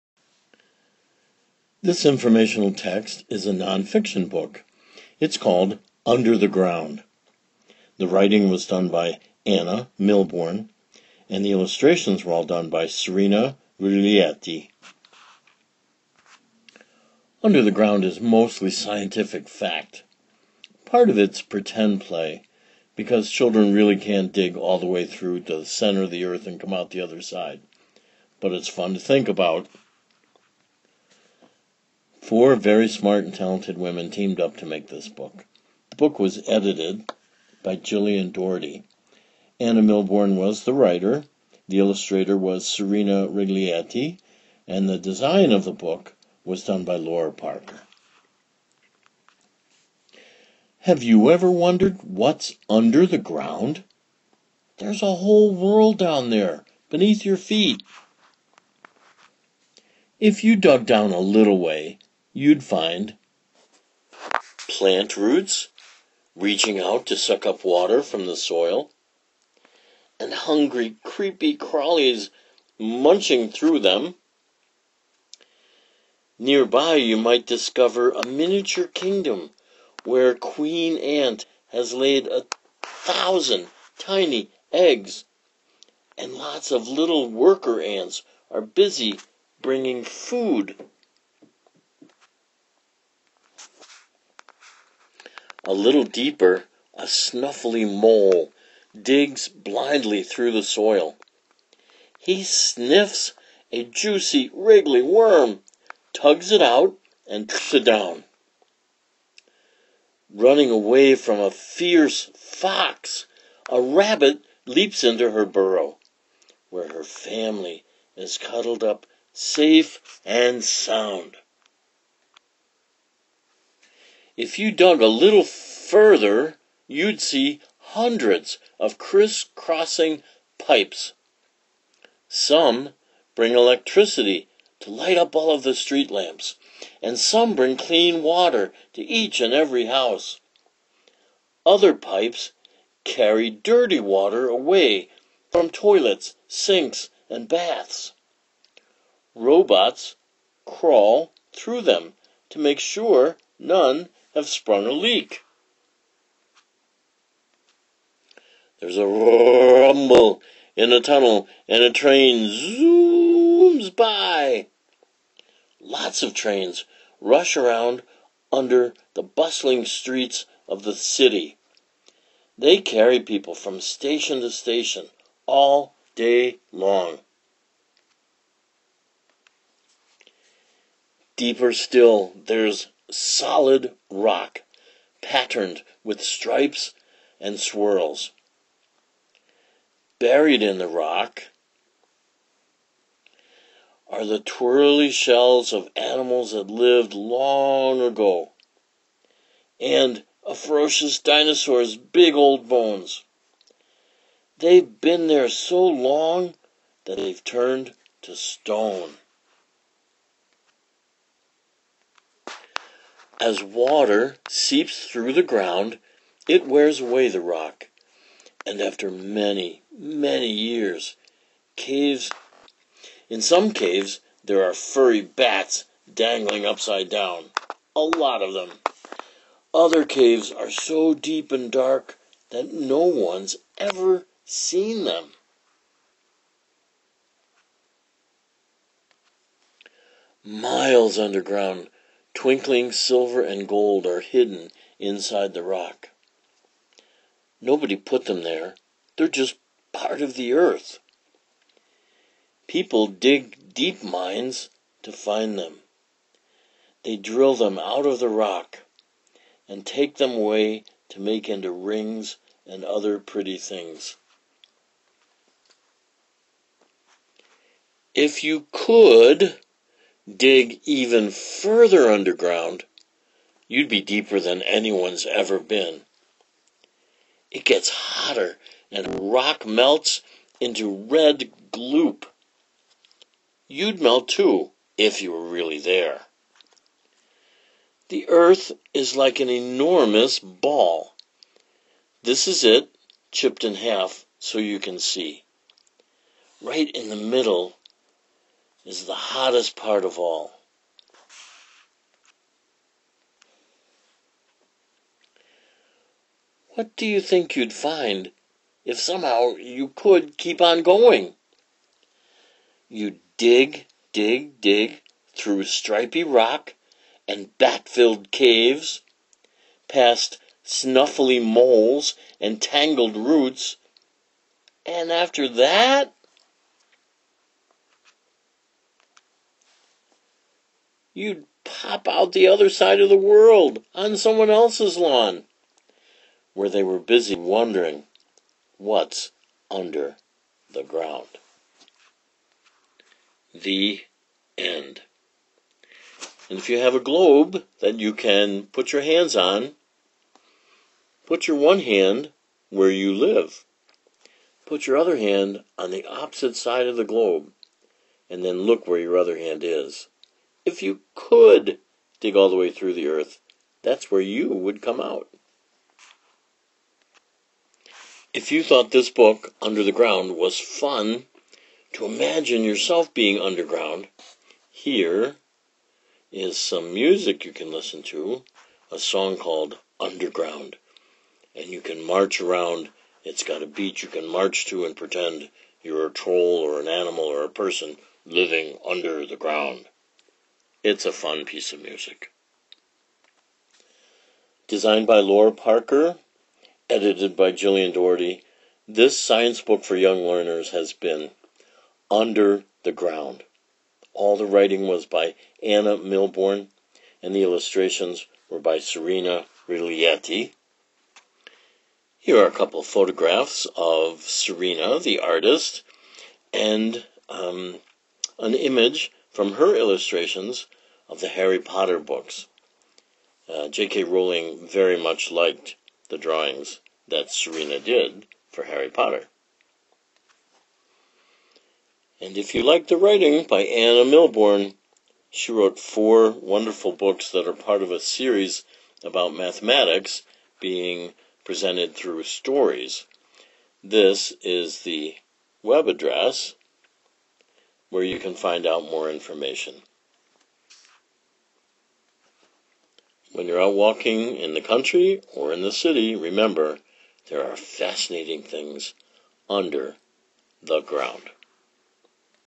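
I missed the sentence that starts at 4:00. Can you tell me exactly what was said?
Miles underground Twinkling silver and gold are hidden inside the rock.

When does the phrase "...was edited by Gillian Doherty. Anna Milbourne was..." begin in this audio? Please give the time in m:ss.
0:36.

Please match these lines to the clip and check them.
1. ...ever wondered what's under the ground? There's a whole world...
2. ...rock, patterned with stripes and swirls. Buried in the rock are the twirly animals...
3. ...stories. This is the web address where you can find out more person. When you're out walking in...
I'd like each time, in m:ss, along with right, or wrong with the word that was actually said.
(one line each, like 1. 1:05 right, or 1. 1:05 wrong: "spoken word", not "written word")
1. 0:51 right
2. 3:04 wrong: "shells", not "animals"
3. 7:22 wrong: "information", not "person".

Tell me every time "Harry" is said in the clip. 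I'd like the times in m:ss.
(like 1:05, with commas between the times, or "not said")
7:01, 7:08.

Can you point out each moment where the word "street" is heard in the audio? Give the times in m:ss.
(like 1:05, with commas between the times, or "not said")
2:15, 2:49.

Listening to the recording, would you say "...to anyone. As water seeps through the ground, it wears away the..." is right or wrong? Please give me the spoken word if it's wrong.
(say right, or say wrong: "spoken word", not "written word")
wrong: "stone", not "anyone".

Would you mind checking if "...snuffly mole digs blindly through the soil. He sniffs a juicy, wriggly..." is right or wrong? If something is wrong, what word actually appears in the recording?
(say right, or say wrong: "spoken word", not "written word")
right.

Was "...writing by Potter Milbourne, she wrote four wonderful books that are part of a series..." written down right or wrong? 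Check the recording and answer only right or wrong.
wrong.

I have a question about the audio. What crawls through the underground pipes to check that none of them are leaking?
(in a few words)
Robots.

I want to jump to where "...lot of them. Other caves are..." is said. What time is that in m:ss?
3:48.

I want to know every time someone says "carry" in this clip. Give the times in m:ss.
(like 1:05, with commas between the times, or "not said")
2:23, 2:52.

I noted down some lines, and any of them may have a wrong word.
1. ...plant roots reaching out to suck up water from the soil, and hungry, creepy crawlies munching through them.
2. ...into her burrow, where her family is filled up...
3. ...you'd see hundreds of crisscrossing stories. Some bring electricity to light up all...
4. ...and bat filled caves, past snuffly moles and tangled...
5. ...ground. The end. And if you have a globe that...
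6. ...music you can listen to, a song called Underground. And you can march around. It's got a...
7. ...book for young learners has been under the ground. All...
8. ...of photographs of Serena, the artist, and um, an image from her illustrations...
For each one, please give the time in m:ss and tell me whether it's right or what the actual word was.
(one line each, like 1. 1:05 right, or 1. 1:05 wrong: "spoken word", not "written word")
1. 1:04 right
2. 1:55 wrong: "cuddled", not "filled"
3. 2:06 wrong: "pipes", not "stories"
4. 5:17 right
5. 5:40 right
6. 6:16 right
7. 6:39 right
8. 6:52 right.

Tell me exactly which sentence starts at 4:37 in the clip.
It gets hotter, and rock melts into red gloop.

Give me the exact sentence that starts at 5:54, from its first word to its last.
Put your other hand on the opposite side of the globe, and then look where your other hand is.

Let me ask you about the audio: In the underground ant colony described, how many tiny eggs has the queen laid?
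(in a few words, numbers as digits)
1000.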